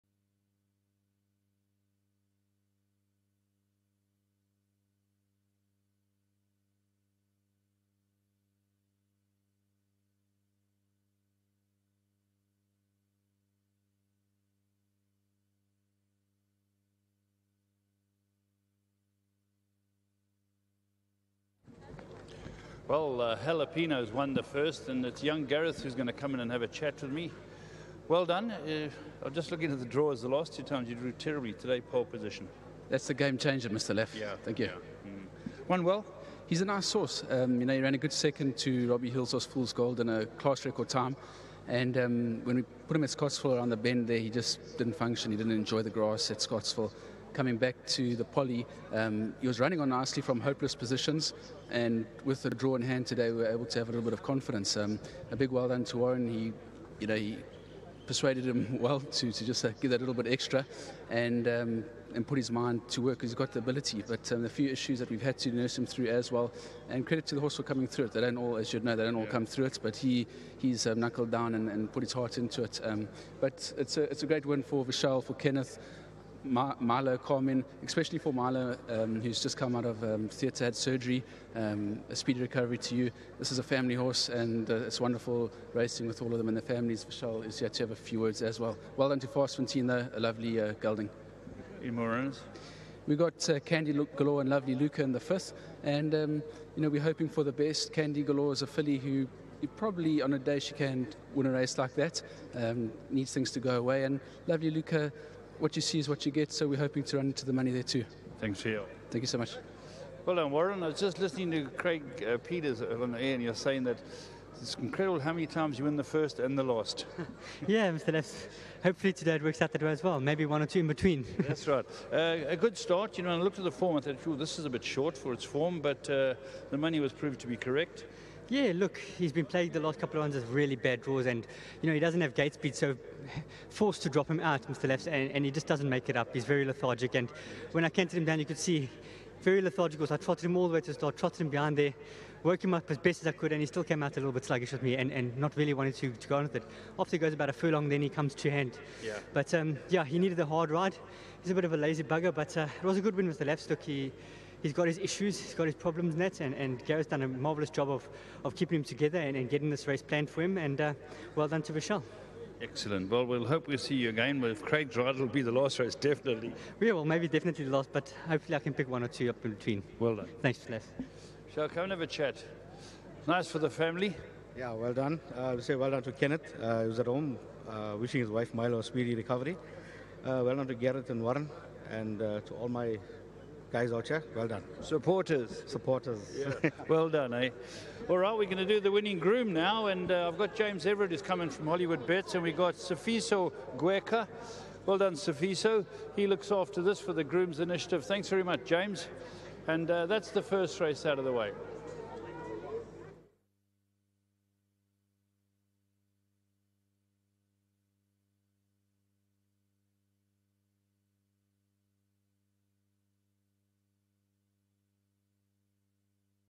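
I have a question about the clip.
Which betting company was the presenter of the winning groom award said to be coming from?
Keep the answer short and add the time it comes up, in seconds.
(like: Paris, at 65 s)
Hollywood Bets, at 191 s.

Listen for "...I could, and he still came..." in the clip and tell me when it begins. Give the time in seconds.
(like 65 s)
143 s.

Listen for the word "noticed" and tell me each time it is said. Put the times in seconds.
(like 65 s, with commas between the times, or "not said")
not said.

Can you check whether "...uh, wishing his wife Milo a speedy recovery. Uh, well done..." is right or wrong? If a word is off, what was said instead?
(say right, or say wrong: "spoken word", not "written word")
right.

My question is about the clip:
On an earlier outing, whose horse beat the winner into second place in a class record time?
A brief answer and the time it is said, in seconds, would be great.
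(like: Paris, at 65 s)
Robbie Hillsaw, at 38 s.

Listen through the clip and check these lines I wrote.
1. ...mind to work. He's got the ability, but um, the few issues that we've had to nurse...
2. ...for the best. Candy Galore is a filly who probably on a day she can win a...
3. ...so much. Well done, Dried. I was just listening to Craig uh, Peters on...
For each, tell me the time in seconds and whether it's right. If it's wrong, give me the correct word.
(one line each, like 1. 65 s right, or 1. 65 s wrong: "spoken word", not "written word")
1. 62 s right
2. 97 s right
3. 109 s wrong: "Warren", not "Dried".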